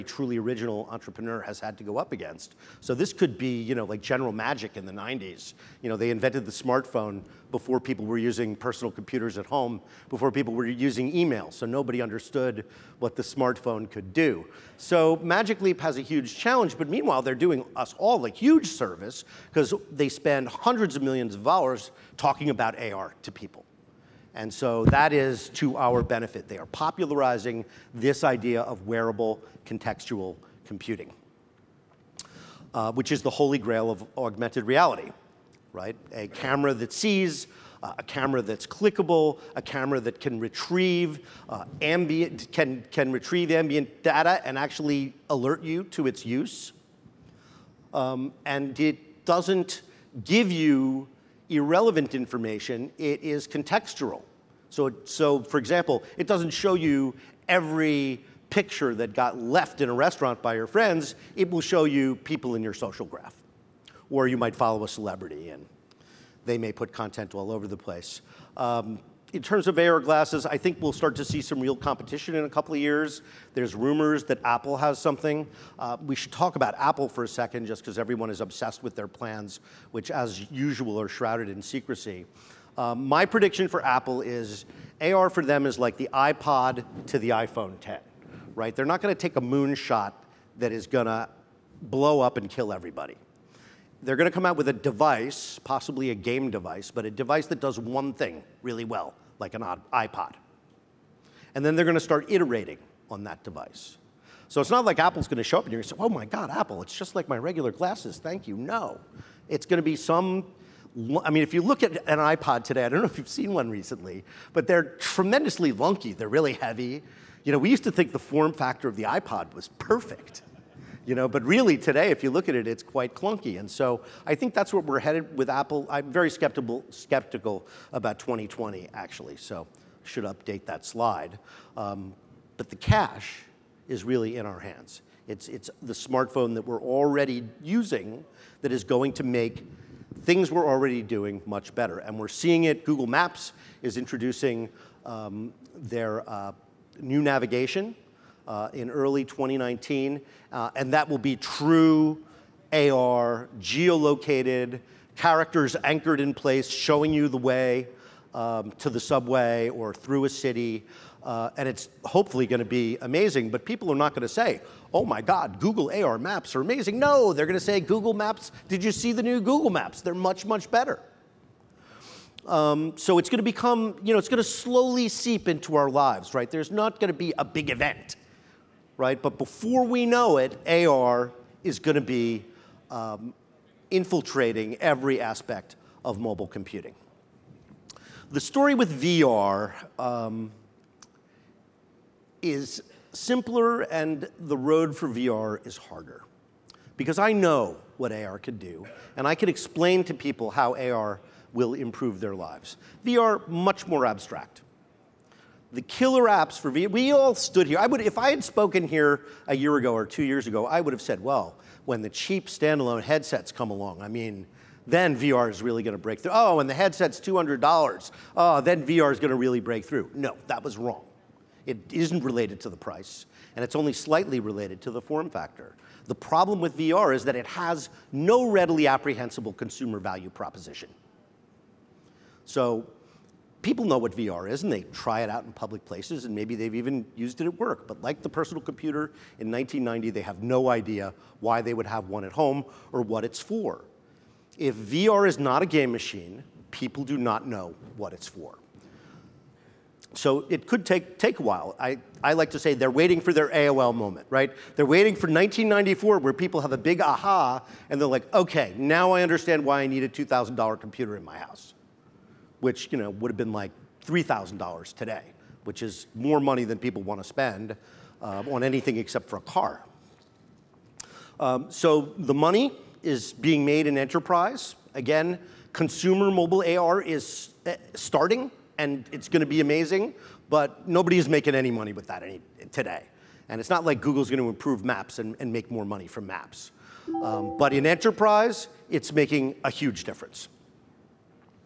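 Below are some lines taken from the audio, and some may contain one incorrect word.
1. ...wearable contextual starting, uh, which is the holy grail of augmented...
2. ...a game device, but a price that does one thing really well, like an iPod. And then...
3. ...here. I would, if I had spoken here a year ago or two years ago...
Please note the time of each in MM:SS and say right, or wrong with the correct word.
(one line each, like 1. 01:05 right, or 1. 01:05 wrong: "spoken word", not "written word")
1. 00:28 wrong: "computing", not "starting"
2. 01:36 wrong: "device", not "price"
3. 03:27 right.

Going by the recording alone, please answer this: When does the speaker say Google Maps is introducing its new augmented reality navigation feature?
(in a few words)
early 2019.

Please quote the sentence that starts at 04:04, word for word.
If VR is not a game machine, people do not know what it's for so it could take, take a while.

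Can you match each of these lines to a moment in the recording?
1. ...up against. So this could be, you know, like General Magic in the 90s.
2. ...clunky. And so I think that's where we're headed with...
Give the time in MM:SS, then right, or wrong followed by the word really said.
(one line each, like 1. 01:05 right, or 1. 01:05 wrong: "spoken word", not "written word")
1. 00:01 right
2. 02:03 right.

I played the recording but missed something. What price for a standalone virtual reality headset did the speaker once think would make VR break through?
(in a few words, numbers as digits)
$200.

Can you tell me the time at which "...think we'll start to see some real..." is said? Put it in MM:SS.
01:10.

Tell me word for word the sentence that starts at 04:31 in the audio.
Um, so the money is being made in enterprise.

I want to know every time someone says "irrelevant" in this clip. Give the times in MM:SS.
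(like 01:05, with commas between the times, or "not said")
00:51.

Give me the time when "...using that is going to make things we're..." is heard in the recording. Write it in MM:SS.
02:17.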